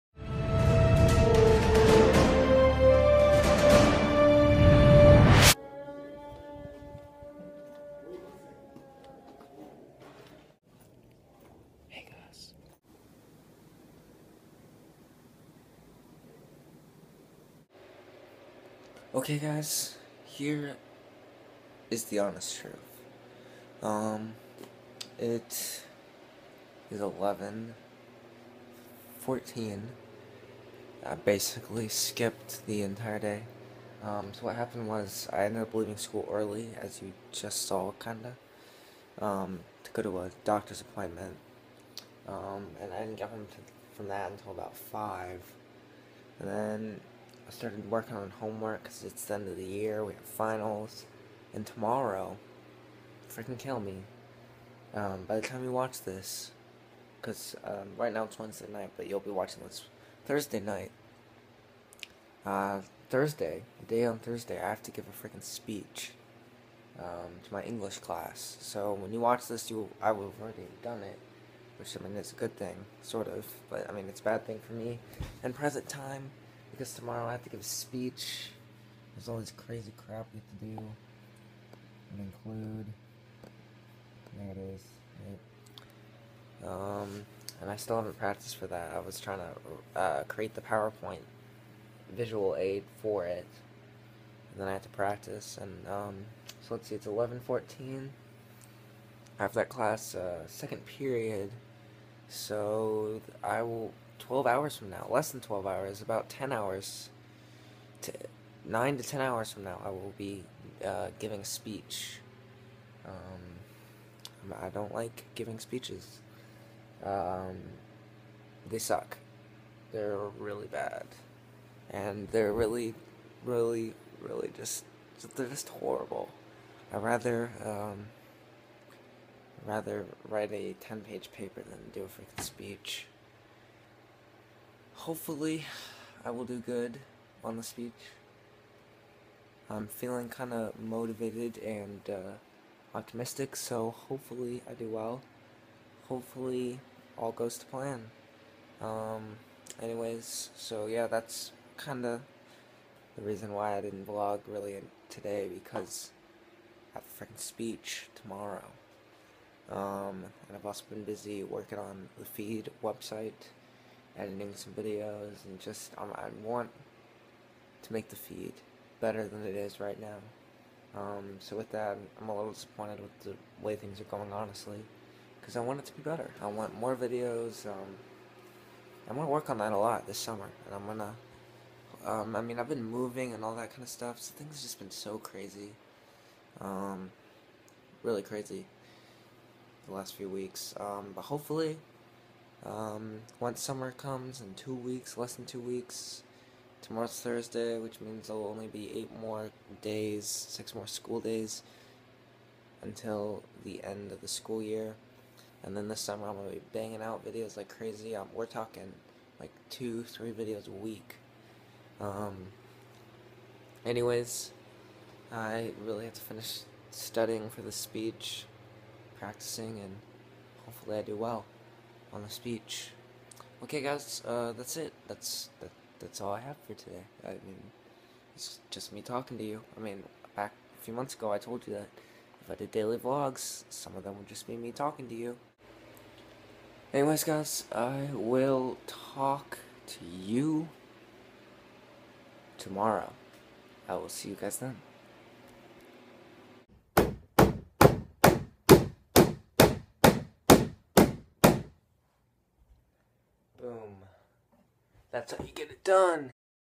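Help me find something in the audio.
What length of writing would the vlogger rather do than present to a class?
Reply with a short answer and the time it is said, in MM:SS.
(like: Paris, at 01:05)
10 pages, at 02:10.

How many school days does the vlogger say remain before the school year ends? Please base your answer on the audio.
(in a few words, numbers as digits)
6.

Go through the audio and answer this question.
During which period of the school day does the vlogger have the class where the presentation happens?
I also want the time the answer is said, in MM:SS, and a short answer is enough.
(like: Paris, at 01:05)
Second period, at 01:40.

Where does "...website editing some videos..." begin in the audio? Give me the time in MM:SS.
02:42.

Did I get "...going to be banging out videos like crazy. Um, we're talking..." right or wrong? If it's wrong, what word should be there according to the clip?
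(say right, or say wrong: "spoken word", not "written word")
right.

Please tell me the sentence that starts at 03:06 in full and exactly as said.
Um, really crazy the last few weeks.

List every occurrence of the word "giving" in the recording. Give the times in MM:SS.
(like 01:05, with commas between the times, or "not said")
01:51, 01:55.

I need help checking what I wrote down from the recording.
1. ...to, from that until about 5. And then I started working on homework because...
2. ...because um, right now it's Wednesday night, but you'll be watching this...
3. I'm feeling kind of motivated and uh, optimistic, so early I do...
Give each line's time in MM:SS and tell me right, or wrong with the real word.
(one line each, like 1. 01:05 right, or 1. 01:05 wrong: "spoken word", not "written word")
1. 00:43 right
2. 00:57 right
3. 02:19 wrong: "hopefully", not "early".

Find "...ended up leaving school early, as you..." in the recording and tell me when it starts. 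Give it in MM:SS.
00:35.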